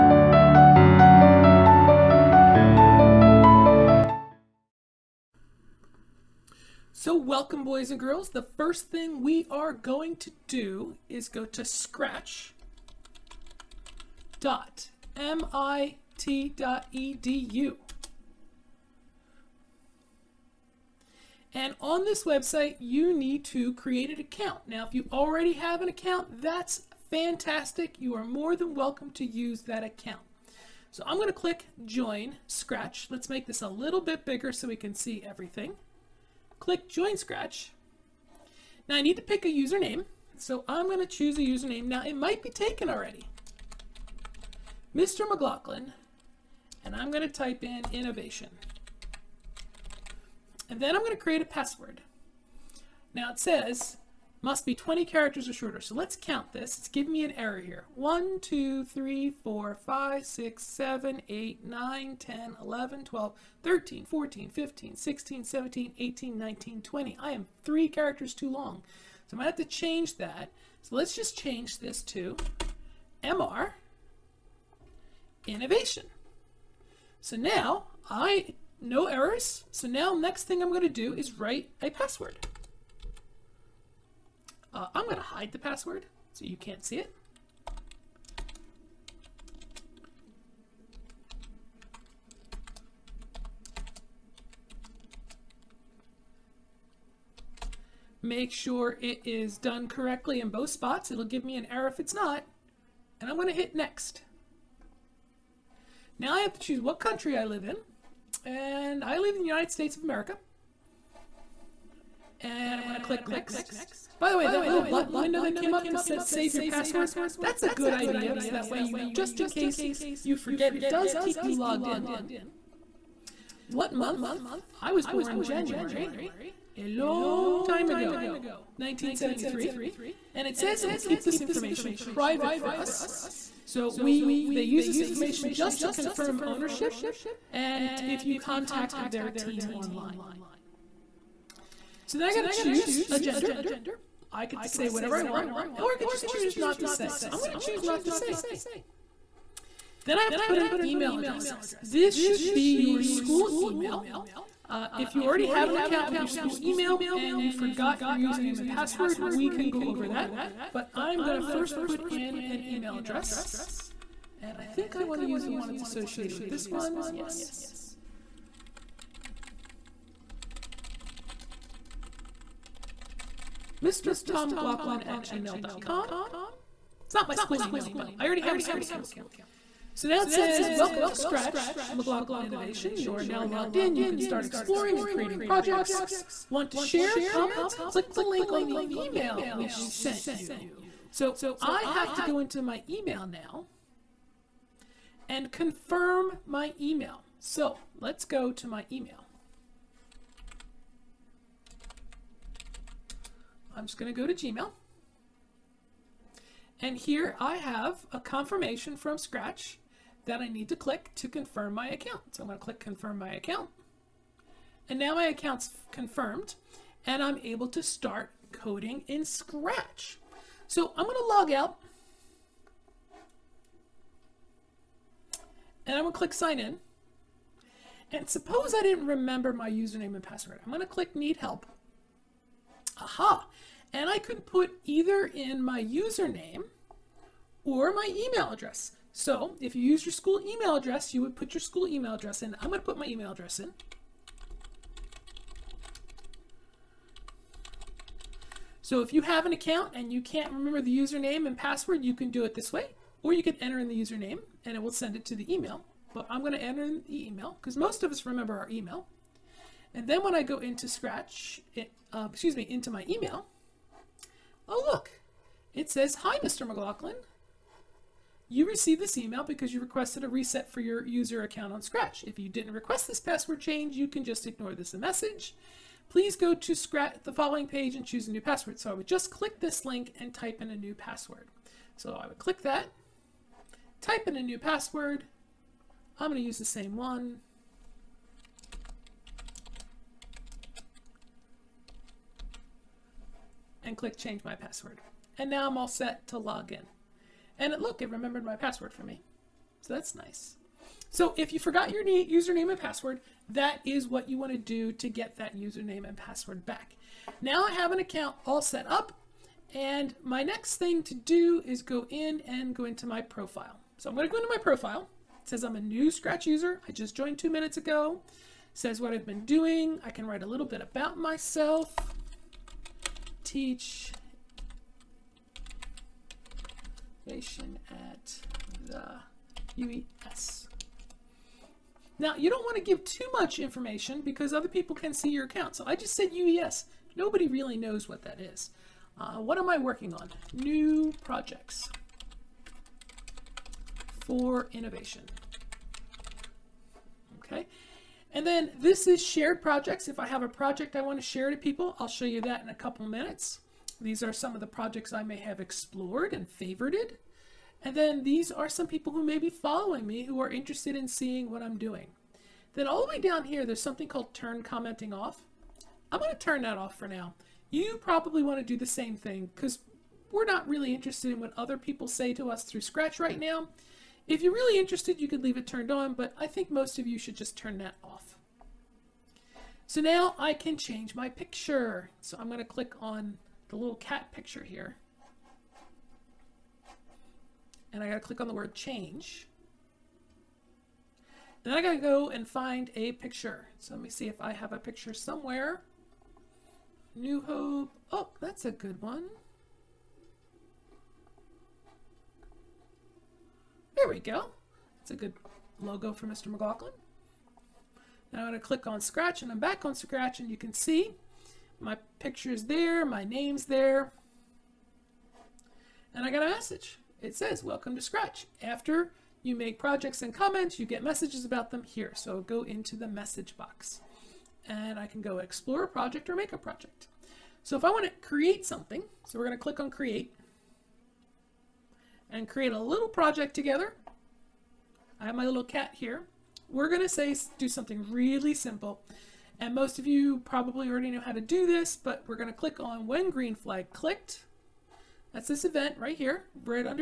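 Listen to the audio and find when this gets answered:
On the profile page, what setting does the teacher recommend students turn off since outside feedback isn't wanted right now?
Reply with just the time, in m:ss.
6:04.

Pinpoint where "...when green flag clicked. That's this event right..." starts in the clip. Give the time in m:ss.
7:23.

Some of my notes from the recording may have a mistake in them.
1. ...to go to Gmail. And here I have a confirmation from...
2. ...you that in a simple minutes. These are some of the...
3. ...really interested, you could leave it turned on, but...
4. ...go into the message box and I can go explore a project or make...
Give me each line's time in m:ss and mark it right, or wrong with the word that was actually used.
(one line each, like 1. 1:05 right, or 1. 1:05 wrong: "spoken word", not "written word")
1. 3:24 right
2. 5:52 wrong: "couple", not "simple"
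3. 6:14 right
4. 7:02 right.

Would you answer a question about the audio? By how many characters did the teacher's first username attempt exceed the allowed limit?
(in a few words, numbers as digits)
3.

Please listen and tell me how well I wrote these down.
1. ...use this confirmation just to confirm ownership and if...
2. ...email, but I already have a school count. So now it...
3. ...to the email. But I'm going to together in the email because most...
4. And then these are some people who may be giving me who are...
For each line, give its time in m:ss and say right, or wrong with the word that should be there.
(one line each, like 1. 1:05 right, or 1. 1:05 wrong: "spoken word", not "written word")
1. 2:14 wrong: "information", not "confirmation"
2. 2:57 wrong: "account", not "count"
3. 4:15 wrong: "enter", not "together"
4. 5:57 wrong: "following", not "giving".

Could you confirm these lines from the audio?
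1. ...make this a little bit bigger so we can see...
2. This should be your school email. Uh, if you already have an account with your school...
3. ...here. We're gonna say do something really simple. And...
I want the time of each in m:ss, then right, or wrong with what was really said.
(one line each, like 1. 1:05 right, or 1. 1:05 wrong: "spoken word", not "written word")
1. 0:33 right
2. 2:31 right
3. 7:15 right.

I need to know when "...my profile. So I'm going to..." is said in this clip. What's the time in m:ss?
5:13.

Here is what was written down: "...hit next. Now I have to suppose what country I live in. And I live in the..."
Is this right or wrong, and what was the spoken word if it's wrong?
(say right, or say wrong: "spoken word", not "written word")
wrong: "choose", not "suppose".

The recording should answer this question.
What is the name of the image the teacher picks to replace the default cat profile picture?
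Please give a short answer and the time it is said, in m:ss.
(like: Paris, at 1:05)
New Hope, at 6:37.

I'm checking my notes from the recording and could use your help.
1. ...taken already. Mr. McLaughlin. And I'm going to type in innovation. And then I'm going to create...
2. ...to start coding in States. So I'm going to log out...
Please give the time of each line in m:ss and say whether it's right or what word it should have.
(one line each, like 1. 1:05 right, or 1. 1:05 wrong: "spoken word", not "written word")
1. 0:42 right
2. 3:37 wrong: "Scratch", not "States".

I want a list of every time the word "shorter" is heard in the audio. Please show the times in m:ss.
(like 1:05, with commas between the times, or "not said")
0:55.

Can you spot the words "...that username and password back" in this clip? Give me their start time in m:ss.
5:05.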